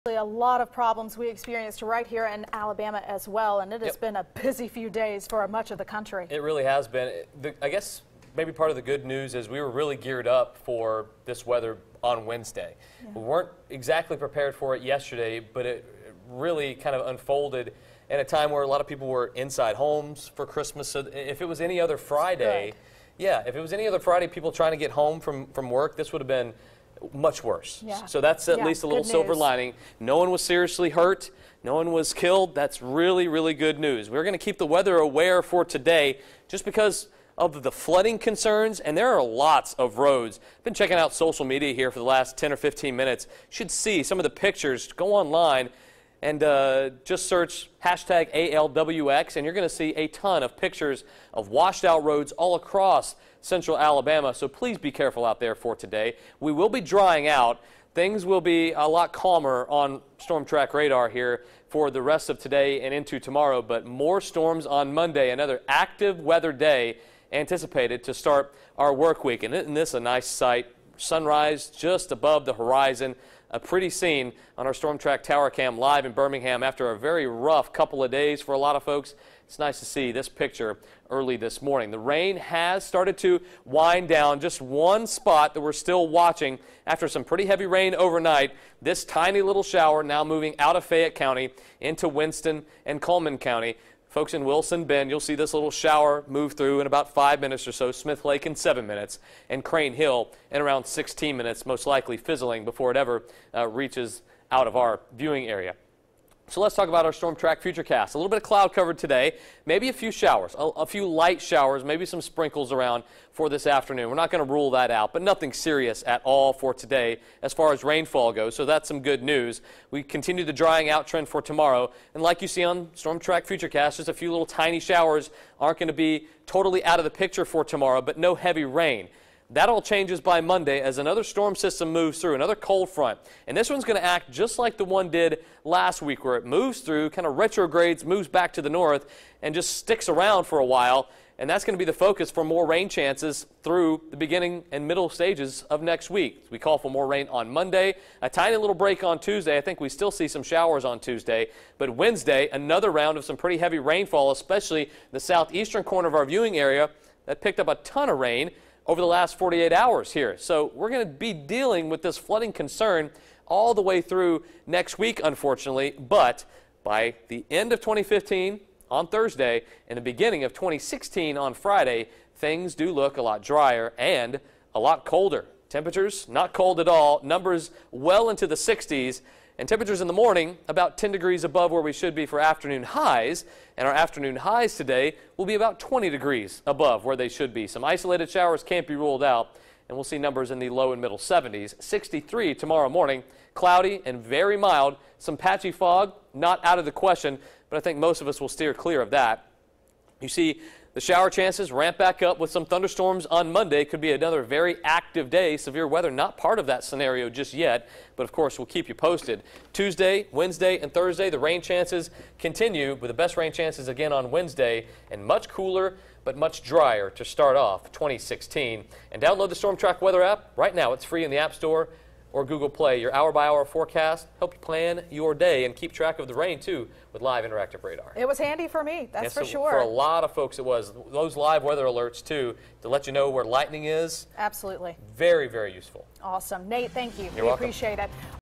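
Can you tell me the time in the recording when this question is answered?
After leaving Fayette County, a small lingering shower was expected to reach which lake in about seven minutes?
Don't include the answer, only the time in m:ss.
1:37.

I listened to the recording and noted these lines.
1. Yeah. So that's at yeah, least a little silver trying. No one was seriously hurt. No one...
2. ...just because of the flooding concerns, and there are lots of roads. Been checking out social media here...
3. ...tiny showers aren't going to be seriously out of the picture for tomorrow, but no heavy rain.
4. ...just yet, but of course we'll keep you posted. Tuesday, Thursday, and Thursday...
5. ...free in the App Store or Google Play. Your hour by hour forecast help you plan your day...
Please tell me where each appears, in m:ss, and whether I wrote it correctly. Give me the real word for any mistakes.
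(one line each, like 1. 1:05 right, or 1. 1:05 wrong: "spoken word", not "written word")
1. 0:27 wrong: "lining", not "trying"
2. 0:36 right
3. 2:04 wrong: "totally", not "seriously"
4. 3:27 wrong: "Wednesday", not "Thursday"
5. 3:41 right.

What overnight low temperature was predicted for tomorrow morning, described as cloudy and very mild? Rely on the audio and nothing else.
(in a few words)
63.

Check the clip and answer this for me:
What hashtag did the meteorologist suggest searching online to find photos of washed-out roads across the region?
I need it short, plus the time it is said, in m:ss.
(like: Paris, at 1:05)
#ALWX, at 0:48.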